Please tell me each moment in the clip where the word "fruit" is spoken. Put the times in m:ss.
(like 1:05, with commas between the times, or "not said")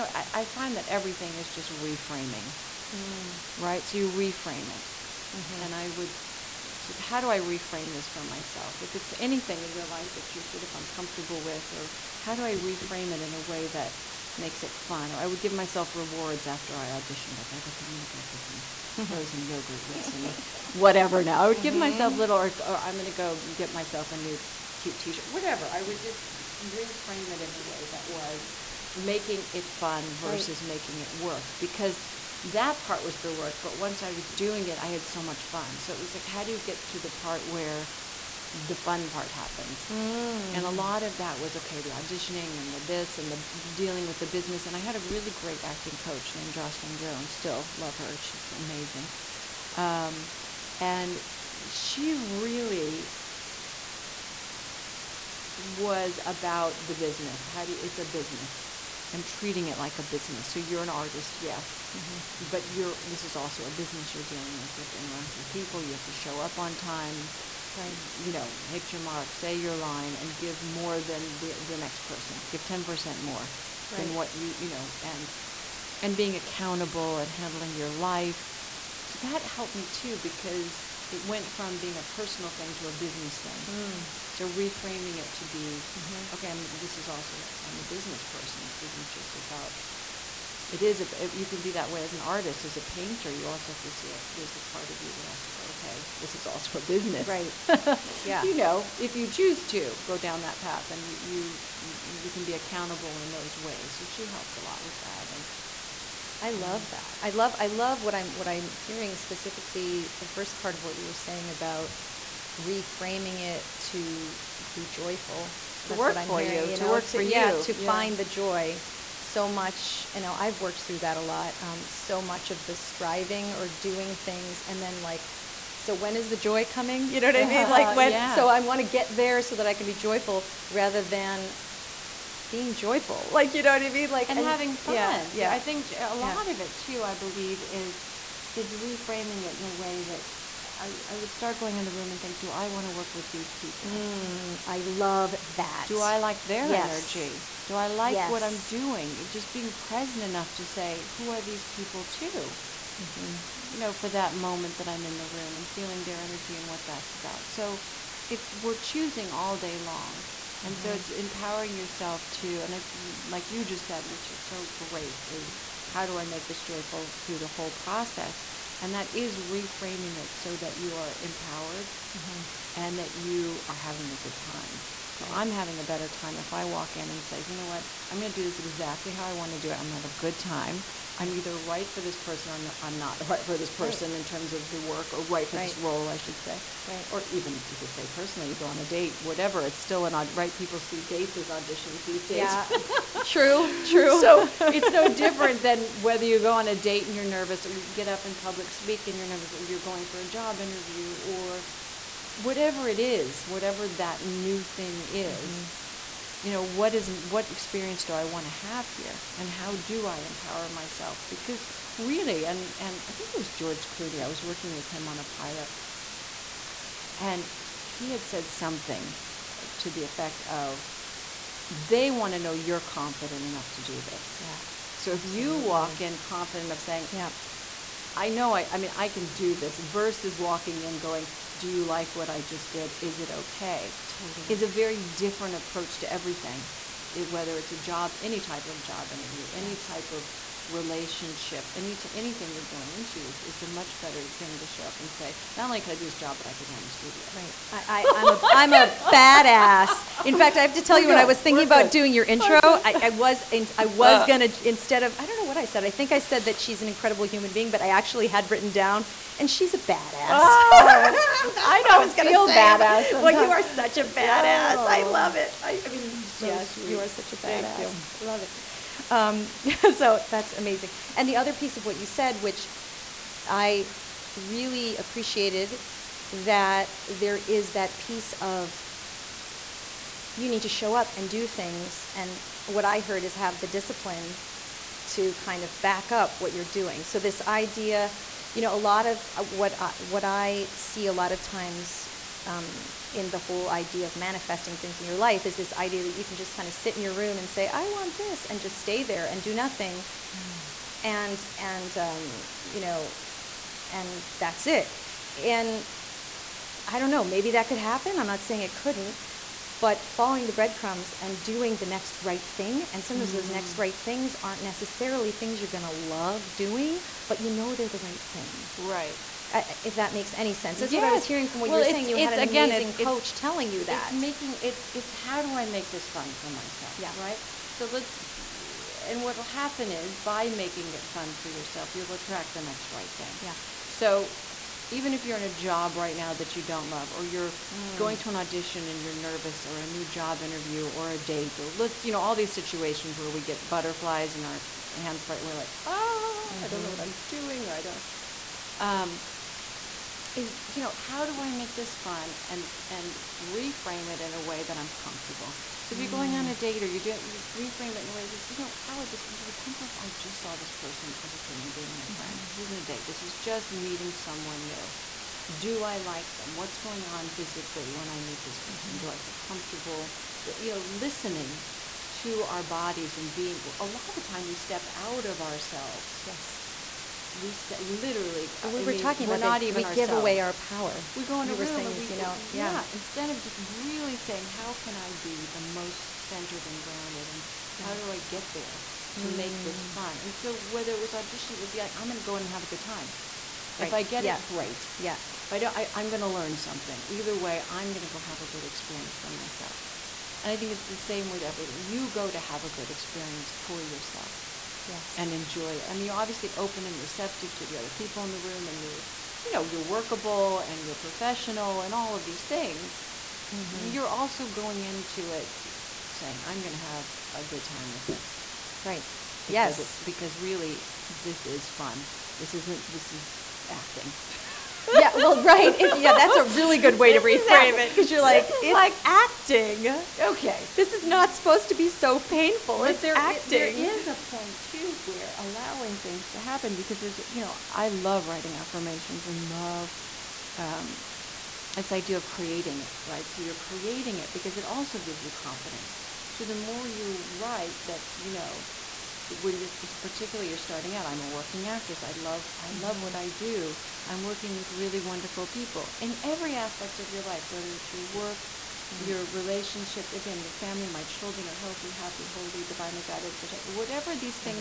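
not said.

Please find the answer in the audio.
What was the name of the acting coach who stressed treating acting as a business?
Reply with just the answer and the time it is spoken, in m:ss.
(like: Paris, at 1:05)
Jocelyn Jones, at 0:46.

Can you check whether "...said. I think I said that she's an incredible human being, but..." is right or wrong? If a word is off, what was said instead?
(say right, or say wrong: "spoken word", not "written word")
right.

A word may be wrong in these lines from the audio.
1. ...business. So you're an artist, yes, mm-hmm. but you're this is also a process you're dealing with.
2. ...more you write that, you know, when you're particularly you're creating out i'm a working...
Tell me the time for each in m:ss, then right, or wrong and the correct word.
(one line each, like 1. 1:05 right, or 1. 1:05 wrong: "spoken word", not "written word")
1. 1:00 wrong: "business", not "process"
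2. 7:26 wrong: "starting", not "creating".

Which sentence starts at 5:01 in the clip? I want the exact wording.
and and um, you know, and that's it.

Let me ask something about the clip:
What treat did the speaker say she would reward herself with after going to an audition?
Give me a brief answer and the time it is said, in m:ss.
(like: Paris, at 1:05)
frozen yogurt, at 0:19.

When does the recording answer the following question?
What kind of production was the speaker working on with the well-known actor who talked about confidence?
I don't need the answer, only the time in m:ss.
3:35.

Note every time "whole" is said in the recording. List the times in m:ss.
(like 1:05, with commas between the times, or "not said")
2:47, 4:53.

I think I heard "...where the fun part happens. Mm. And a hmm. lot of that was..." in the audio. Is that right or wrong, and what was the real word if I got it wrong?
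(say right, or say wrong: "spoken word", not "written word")
right.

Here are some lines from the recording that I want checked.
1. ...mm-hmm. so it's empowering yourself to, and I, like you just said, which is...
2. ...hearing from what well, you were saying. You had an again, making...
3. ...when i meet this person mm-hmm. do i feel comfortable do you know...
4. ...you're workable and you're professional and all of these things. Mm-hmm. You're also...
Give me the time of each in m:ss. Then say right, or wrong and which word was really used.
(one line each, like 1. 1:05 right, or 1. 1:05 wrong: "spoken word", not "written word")
1. 2:40 right
2. 5:21 wrong: "amazing", not "making"
3. 6:07 right
4. 6:49 right.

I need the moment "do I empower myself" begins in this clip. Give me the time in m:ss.
3:29.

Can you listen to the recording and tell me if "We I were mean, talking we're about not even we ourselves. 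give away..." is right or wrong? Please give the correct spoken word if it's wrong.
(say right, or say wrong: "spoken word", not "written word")
right.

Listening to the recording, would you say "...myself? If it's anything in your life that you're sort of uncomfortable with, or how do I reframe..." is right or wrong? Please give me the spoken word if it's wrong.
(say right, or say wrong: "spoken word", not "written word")
right.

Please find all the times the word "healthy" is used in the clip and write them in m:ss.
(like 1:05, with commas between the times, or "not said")
7:41.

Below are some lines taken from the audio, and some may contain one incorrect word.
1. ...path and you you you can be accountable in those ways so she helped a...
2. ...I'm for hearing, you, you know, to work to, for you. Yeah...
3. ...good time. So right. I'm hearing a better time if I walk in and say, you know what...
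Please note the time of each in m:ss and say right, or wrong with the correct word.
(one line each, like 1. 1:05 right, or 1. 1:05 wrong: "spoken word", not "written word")
1. 1:40 right
2. 1:56 right
3. 2:54 wrong: "having", not "hearing".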